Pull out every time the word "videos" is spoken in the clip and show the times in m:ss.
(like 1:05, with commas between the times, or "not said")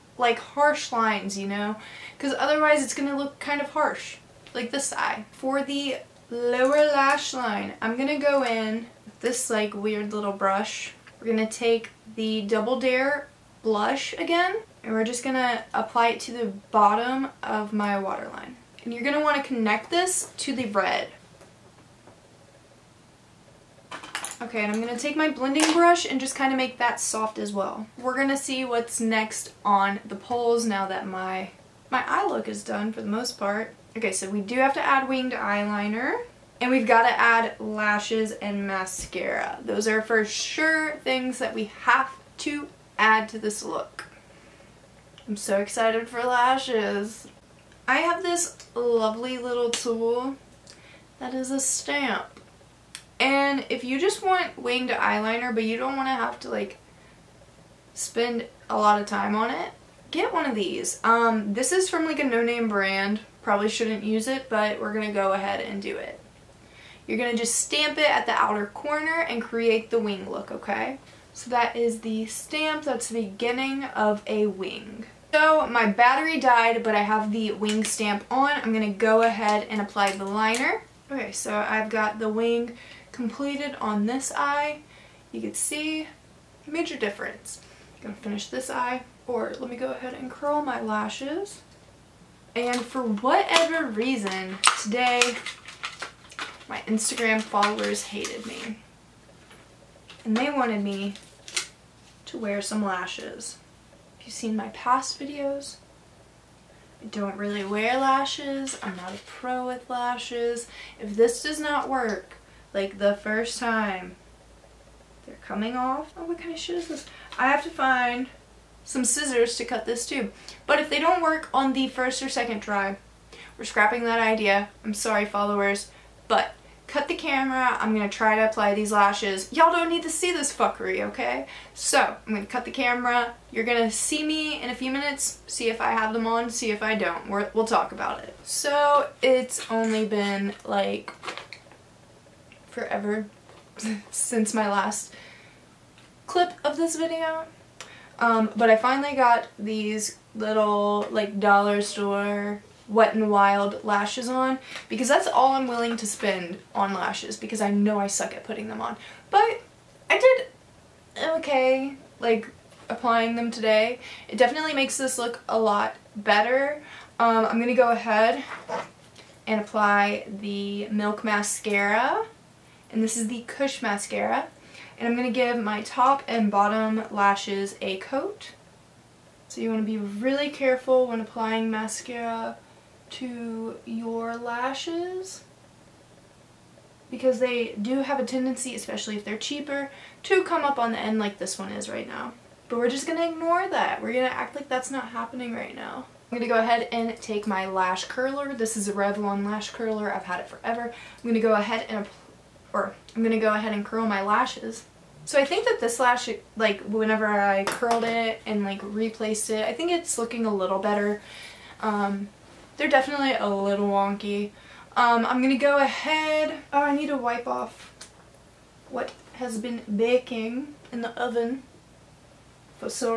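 1:45, 2:26.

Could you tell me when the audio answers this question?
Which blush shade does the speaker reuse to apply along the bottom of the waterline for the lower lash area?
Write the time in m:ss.
0:12.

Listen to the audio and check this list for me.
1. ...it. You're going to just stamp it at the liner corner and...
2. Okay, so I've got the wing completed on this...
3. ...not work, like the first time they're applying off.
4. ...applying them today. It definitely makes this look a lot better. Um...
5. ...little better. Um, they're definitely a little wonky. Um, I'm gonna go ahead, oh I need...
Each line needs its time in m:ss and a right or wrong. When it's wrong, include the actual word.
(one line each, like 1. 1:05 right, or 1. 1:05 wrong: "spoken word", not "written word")
1. 1:05 wrong: "outer", not "liner"
2. 1:21 right
3. 1:51 wrong: "coming", not "applying"
4. 2:42 right
5. 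3:30 right.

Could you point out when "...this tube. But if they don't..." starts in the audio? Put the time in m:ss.
1:59.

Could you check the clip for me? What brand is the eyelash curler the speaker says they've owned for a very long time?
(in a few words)
Revlon.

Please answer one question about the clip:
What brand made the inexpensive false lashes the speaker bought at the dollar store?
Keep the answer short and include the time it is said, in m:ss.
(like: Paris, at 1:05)
Wet and Wild, at 2:32.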